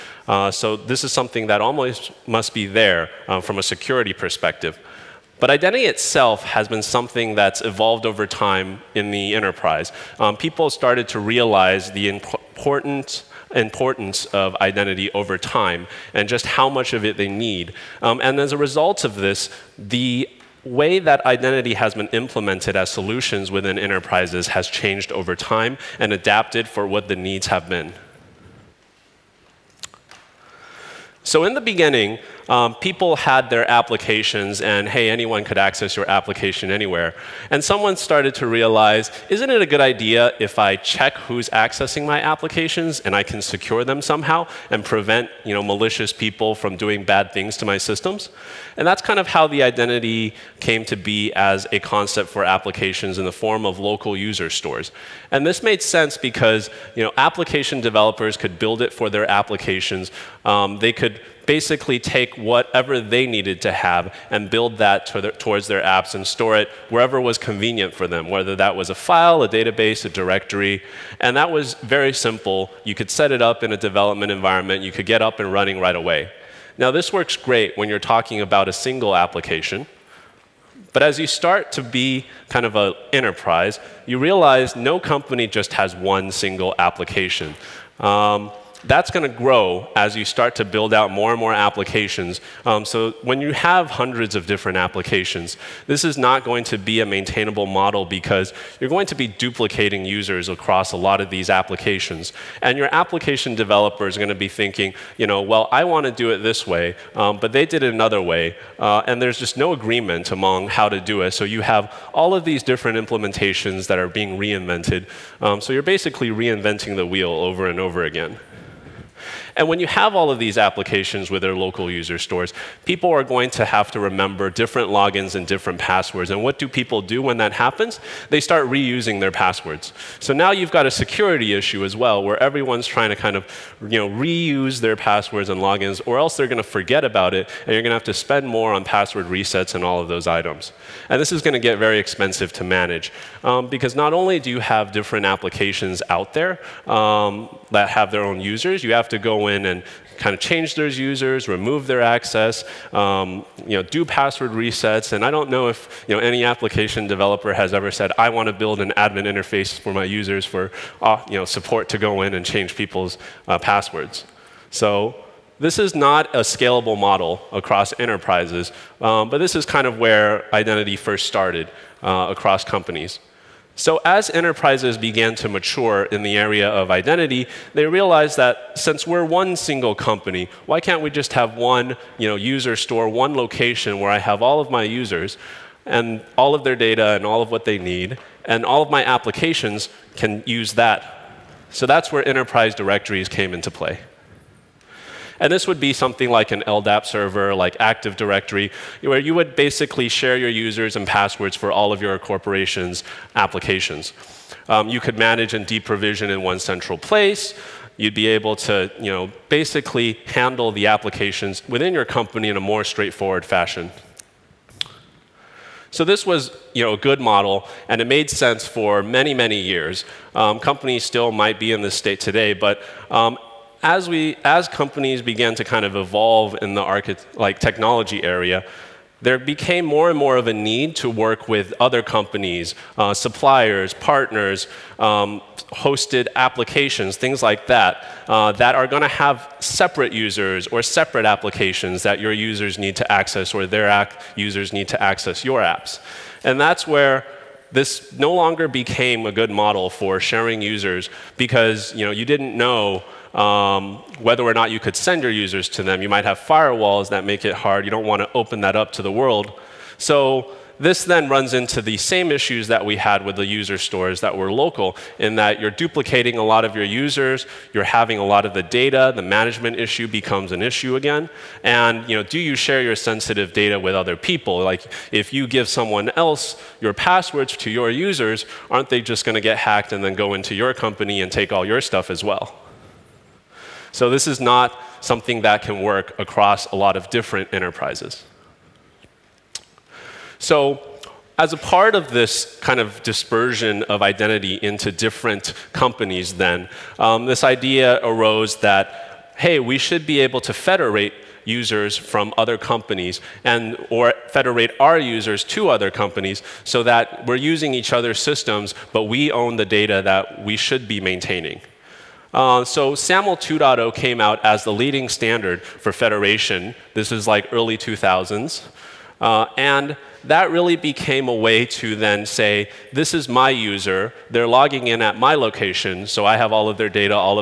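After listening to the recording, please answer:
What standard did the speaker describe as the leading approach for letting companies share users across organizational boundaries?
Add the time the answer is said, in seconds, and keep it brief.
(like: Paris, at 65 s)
SAML 2.0, at 312 s.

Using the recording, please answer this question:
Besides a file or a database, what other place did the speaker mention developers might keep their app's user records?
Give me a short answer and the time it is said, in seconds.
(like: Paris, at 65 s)
a directory, at 70 s.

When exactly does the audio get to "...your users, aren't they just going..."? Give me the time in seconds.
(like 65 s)
277 s.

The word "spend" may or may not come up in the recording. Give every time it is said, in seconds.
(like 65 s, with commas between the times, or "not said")
138 s.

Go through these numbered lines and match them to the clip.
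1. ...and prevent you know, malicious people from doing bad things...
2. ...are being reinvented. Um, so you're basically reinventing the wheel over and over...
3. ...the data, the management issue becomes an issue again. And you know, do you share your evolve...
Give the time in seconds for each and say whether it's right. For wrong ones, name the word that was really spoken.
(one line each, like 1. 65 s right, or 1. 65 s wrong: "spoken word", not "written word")
1. 44 s right
2. 113 s right
3. 268 s wrong: "sensitive", not "evolve".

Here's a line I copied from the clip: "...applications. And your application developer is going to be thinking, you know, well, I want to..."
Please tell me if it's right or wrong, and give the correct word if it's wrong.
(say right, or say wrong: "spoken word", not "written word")
right.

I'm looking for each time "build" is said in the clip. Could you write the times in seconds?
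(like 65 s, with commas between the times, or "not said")
58 s, 64 s, 90 s, 158 s.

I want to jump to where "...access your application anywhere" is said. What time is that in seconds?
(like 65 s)
35 s.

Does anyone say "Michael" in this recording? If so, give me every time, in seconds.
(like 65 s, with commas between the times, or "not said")
not said.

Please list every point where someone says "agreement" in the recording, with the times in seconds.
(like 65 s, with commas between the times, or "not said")
109 s.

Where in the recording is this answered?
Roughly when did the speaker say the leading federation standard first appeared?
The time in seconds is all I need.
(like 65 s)
317 s.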